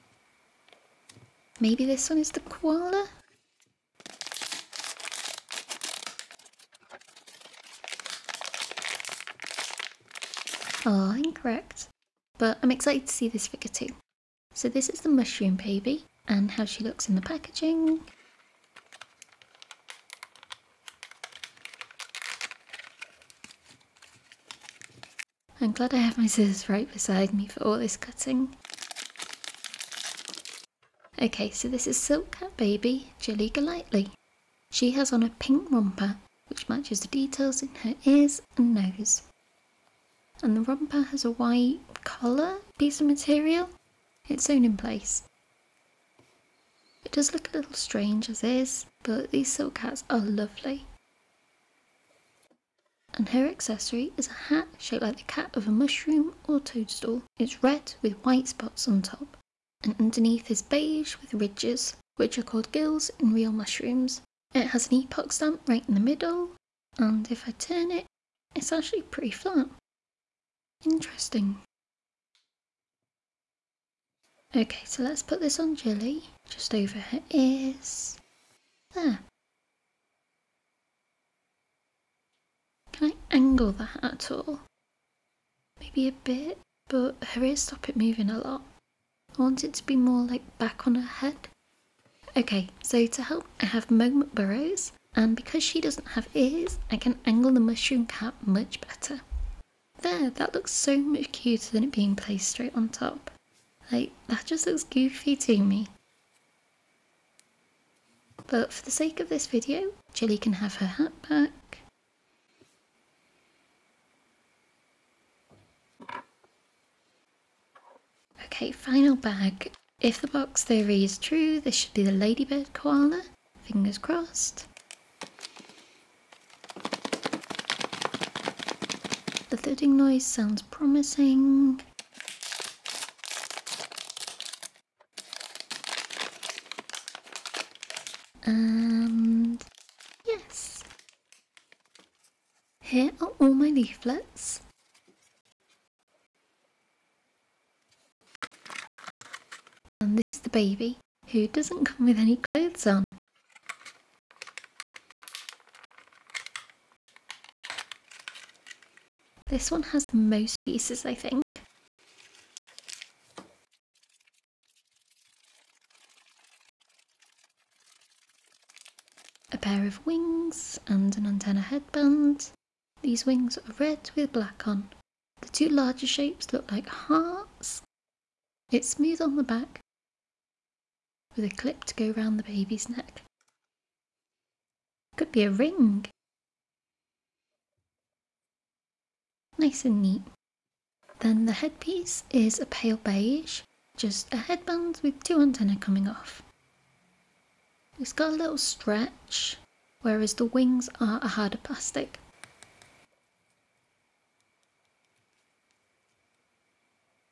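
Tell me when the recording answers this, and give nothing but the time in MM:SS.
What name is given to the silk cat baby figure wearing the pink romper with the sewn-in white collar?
00:33.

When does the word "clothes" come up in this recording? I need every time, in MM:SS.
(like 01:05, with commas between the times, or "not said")
02:32.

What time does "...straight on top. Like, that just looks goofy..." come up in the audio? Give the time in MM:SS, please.
01:42.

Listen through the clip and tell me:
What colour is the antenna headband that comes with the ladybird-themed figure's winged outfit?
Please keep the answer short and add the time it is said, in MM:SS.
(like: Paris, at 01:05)
pale beige, at 03:12.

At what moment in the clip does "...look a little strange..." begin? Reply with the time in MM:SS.
00:47.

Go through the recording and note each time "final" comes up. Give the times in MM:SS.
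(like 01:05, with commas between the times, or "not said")
01:58.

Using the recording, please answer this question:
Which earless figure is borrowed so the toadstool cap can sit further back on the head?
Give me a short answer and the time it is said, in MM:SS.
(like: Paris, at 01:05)
Moment Burrows, at 01:33.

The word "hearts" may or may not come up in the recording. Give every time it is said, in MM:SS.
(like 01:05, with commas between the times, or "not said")
02:56.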